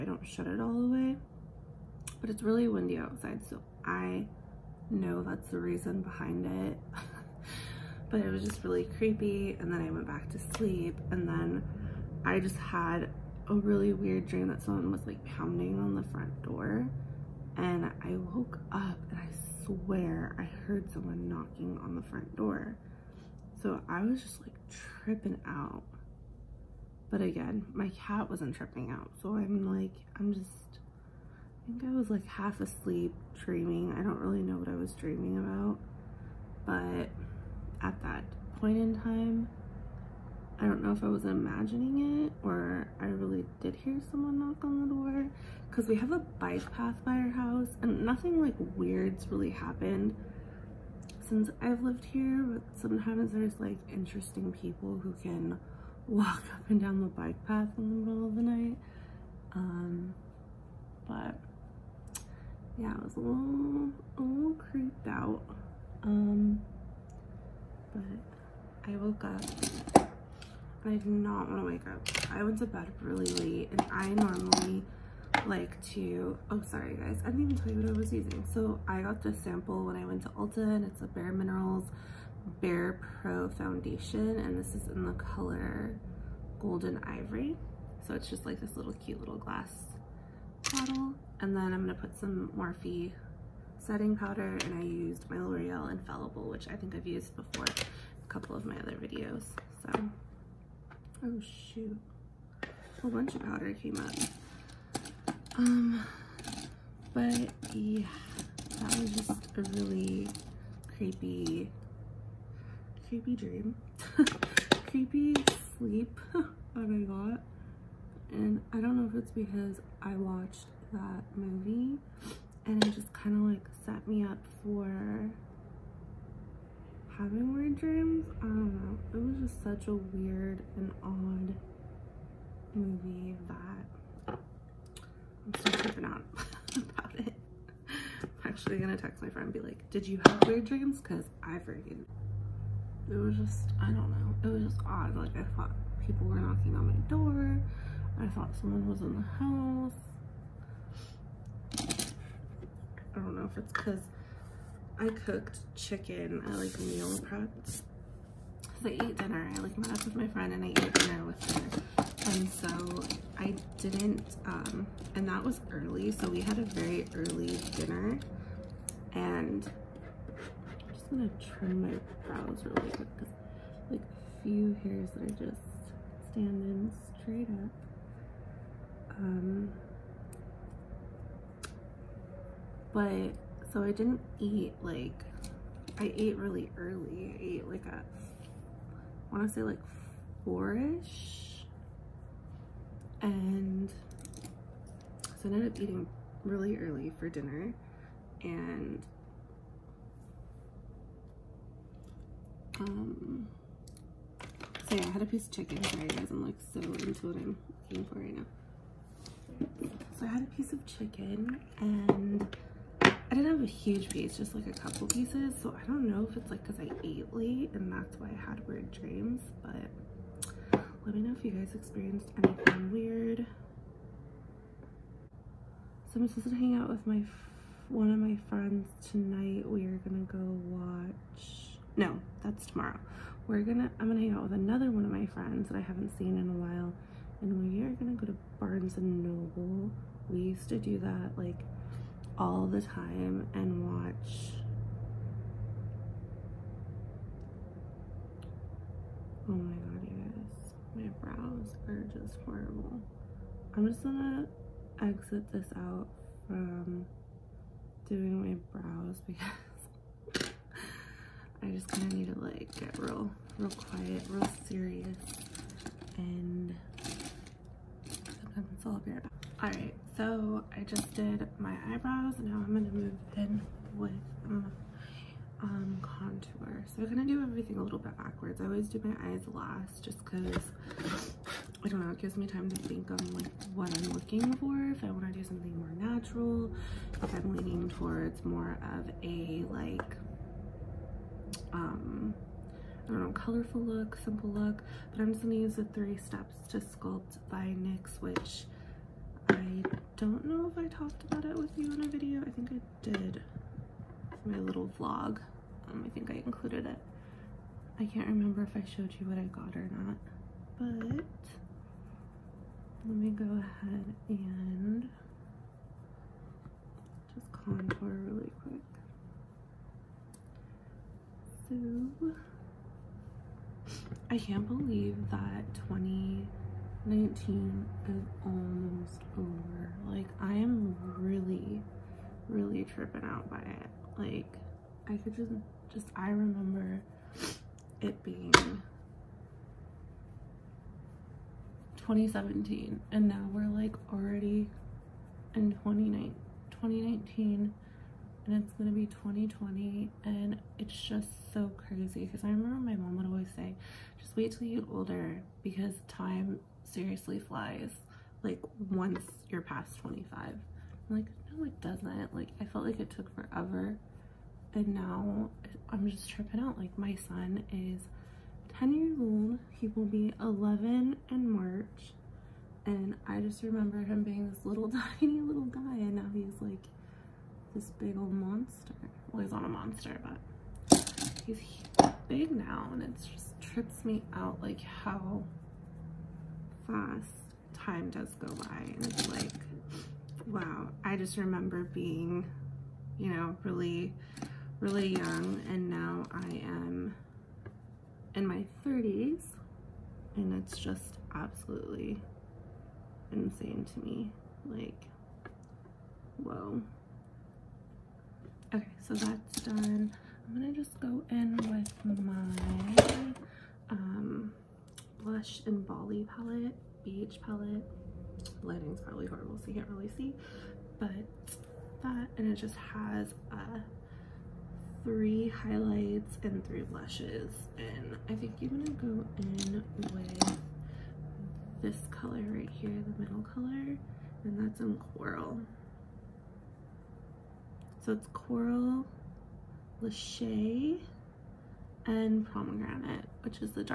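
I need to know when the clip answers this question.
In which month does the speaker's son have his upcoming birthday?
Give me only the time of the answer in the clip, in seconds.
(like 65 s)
371 s.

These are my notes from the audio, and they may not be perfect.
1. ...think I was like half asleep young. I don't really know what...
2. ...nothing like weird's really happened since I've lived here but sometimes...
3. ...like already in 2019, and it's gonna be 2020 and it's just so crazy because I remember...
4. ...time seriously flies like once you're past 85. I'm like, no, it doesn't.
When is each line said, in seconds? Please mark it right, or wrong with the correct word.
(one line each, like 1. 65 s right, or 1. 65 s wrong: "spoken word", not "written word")
1. 31 s wrong: "dreaming", not "young"
2. 48 s right
3. 343 s right
4. 356 s wrong: "25", not "85".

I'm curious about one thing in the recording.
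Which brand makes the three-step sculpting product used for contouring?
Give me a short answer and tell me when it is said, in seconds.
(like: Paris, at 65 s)
NYX, at 297 s.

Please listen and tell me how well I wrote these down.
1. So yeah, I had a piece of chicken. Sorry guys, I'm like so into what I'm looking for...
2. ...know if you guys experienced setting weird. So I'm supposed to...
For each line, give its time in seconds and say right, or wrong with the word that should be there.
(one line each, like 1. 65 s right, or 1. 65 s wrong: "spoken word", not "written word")
1. 204 s right
2. 221 s wrong: "anything", not "setting".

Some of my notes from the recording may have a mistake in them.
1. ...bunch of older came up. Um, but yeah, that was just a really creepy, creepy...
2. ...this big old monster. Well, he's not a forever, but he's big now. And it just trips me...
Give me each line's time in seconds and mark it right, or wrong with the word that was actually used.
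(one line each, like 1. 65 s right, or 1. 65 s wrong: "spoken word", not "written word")
1. 103 s wrong: "powder", not "older"
2. 377 s wrong: "monster", not "forever".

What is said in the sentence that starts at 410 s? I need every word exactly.
I'm gonna just go in with my um, blush and Bali palette, beige palette.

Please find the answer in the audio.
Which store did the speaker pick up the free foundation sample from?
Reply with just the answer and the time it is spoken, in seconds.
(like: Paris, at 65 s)
Ulta, at 80 s.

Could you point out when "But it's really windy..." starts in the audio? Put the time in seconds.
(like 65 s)
2 s.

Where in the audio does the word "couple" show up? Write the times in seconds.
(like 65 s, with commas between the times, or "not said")
98 s, 214 s.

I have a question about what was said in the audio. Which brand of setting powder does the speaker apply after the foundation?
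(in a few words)
Morphe.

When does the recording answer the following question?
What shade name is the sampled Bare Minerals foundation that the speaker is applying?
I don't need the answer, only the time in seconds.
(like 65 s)
86 s.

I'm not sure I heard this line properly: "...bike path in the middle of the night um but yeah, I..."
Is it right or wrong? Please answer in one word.
right.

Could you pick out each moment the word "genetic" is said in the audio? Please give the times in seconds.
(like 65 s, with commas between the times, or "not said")
not said.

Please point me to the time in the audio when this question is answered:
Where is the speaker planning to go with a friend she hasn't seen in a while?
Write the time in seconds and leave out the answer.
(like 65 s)
238 s.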